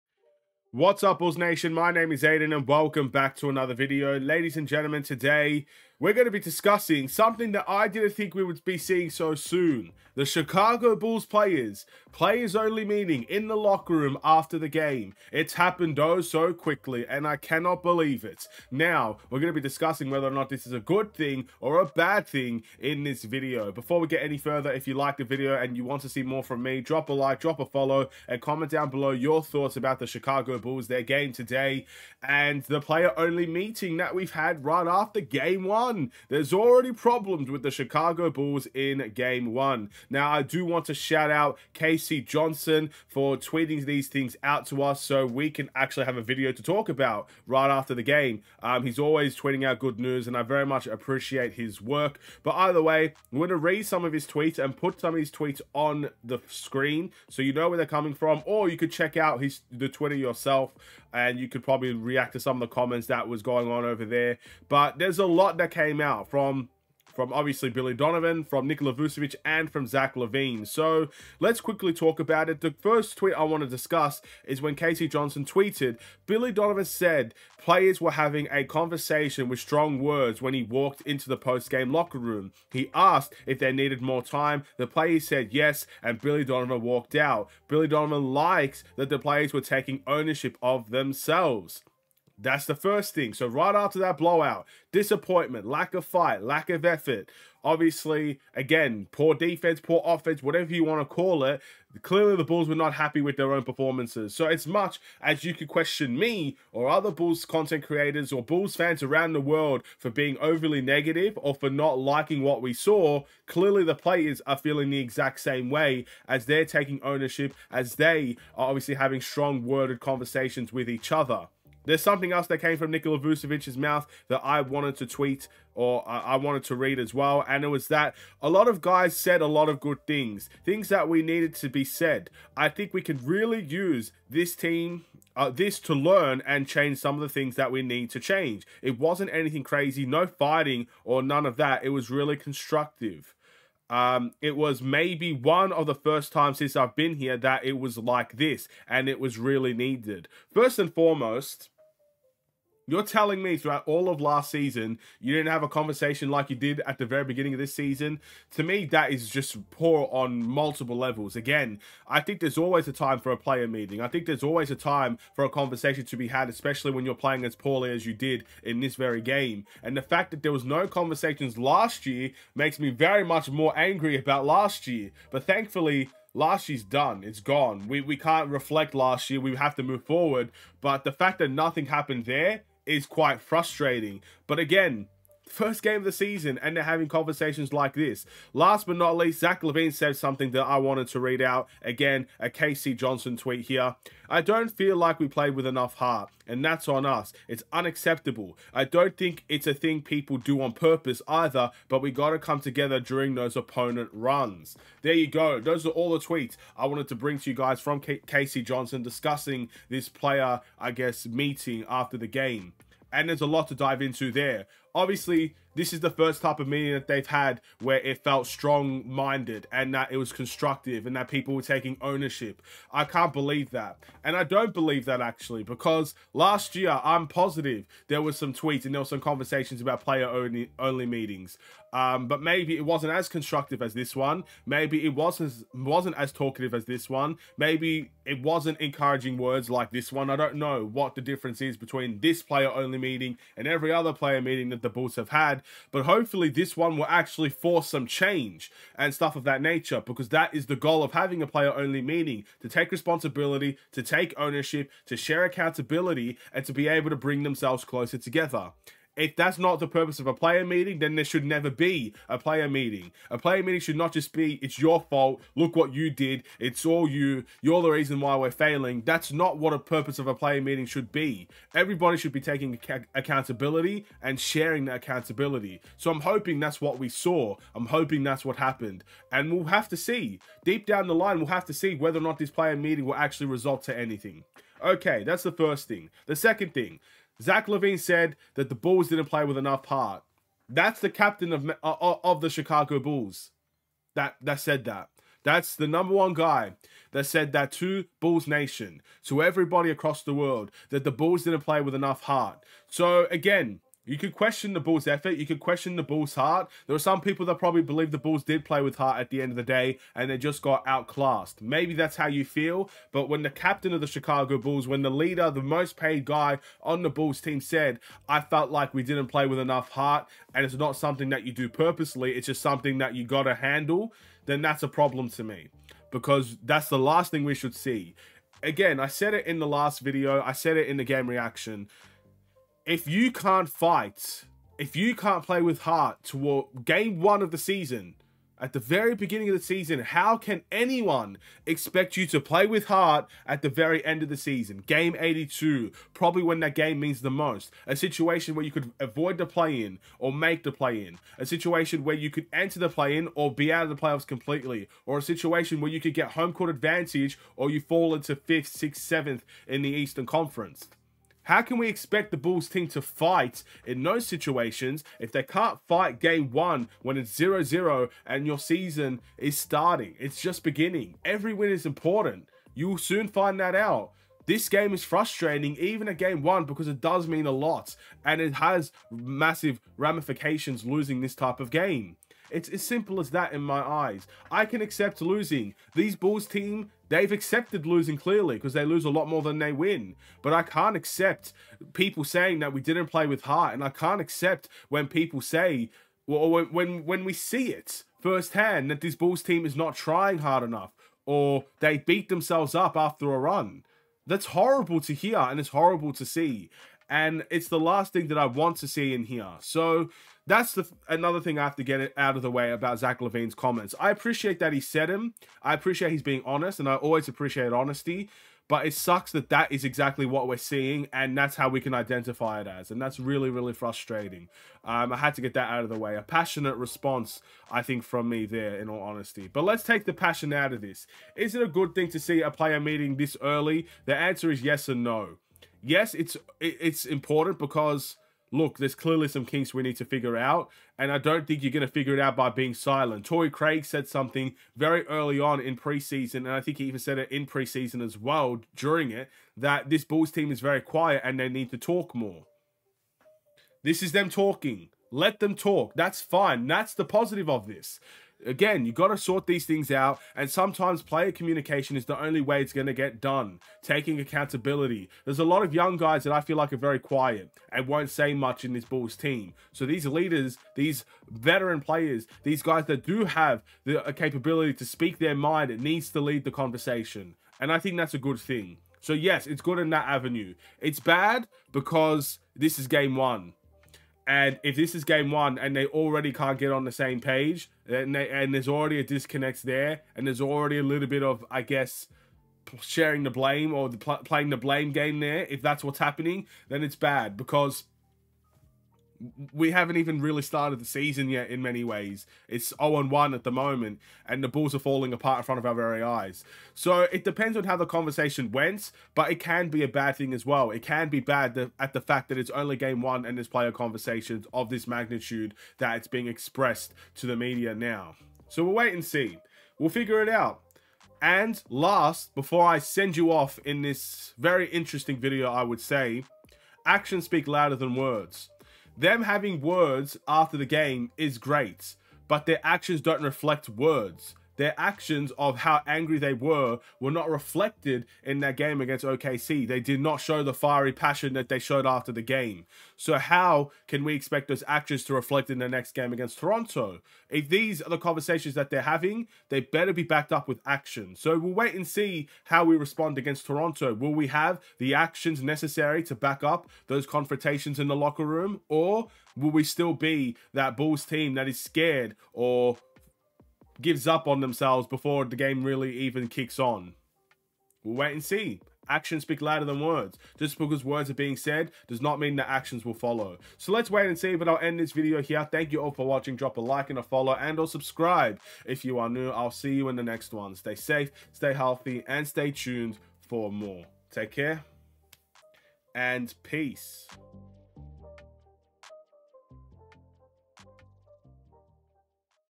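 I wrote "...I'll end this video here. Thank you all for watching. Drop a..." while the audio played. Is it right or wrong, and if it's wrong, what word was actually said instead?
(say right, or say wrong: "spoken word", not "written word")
right.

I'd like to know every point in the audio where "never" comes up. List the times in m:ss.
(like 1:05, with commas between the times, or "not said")
4:21.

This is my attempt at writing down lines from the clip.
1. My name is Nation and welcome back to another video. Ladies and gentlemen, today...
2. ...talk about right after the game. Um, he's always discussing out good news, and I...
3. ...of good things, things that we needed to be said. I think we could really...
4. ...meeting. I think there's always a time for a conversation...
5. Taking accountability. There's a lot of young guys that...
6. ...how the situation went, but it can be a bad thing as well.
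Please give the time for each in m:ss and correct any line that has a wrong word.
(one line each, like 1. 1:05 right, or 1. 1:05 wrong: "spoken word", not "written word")
1. 0:01 wrong: "Aidan", not "Nation"
2. 0:46 wrong: "tweeting", not "discussing"
3. 2:09 right
4. 2:43 right
5. 7:43 right
6. 8:27 wrong: "conversation", not "situation".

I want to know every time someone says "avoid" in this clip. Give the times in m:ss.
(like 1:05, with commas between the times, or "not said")
5:48.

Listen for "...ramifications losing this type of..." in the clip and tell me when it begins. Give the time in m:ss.
6:19.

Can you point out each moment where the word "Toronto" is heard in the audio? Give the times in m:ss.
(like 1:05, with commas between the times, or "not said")
9:06, 9:13.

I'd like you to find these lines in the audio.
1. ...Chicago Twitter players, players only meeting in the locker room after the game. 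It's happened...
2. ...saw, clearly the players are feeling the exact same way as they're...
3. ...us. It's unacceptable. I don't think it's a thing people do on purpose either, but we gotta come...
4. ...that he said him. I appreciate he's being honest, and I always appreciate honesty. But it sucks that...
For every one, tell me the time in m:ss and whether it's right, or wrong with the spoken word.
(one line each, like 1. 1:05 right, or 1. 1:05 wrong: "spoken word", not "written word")
1. 0:10 wrong: "Bulls", not "Twitter"
2. 1:52 right
3. 3:17 right
4. 6:54 right.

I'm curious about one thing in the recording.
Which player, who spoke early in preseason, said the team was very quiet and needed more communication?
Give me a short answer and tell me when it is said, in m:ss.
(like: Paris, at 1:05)
Torrey Craig, at 7:23.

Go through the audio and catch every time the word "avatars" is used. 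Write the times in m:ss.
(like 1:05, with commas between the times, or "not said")
not said.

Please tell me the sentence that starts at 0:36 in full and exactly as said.
There's already problems with the Chicago Bulls in game one.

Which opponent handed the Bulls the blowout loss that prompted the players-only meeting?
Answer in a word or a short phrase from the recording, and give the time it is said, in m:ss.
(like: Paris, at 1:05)
OKC, at 8:59.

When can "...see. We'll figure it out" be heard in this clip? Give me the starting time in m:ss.
8:39.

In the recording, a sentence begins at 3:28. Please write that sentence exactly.
Johnson discussing this player, I guess, meeting after the game and there's a lot to dive into there.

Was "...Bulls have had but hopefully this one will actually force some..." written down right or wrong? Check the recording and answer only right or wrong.
right.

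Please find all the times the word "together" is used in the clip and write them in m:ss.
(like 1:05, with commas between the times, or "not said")
3:22, 4:18.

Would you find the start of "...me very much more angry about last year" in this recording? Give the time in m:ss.
2:52.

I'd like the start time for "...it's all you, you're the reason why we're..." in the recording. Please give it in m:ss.
4:26.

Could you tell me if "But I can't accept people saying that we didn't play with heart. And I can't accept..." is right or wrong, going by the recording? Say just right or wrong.
right.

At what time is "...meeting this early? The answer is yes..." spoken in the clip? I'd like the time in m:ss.
7:12.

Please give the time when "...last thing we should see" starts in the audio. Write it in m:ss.
5:26.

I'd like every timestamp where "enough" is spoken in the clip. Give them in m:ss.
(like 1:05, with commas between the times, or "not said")
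3:15, 4:49, 5:01, 5:19, 6:40.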